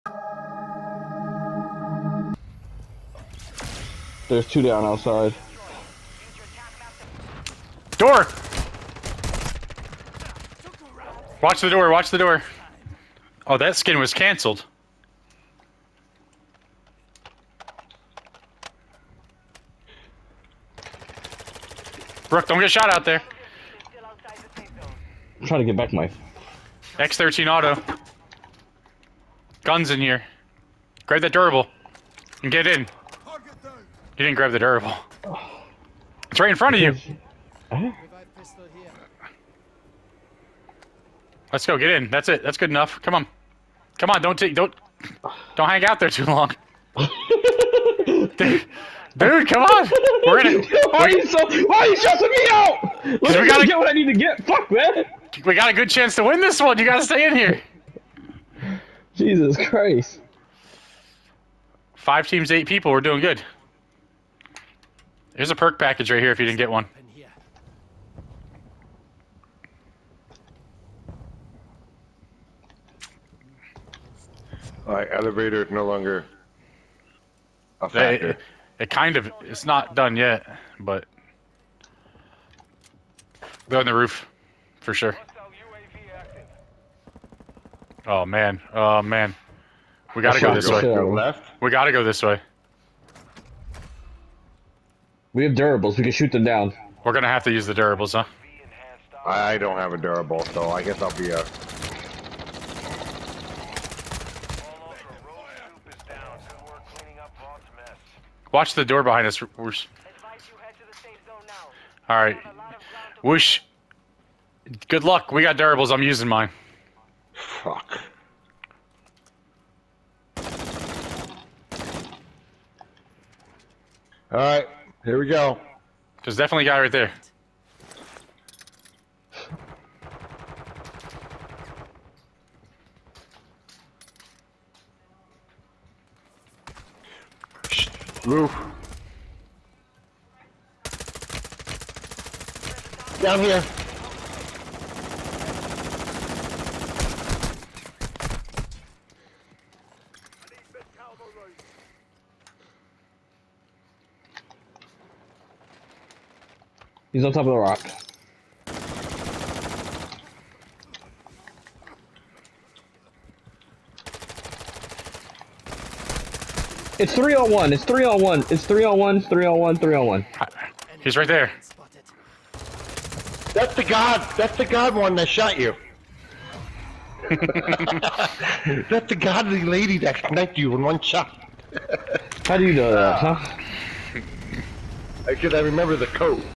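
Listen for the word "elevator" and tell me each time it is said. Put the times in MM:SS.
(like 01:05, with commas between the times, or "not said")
01:15.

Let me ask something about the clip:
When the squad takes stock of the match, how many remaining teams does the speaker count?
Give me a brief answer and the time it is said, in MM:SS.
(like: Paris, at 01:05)
5, at 01:01.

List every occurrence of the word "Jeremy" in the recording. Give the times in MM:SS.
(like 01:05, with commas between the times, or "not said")
not said.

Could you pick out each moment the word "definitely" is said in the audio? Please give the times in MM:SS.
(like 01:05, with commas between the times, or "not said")
02:06.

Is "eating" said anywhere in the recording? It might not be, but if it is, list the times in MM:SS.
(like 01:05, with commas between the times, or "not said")
not said.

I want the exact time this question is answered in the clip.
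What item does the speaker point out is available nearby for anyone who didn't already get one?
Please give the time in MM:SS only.
01:05.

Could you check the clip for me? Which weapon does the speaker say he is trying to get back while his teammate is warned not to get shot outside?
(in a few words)
X13 auto.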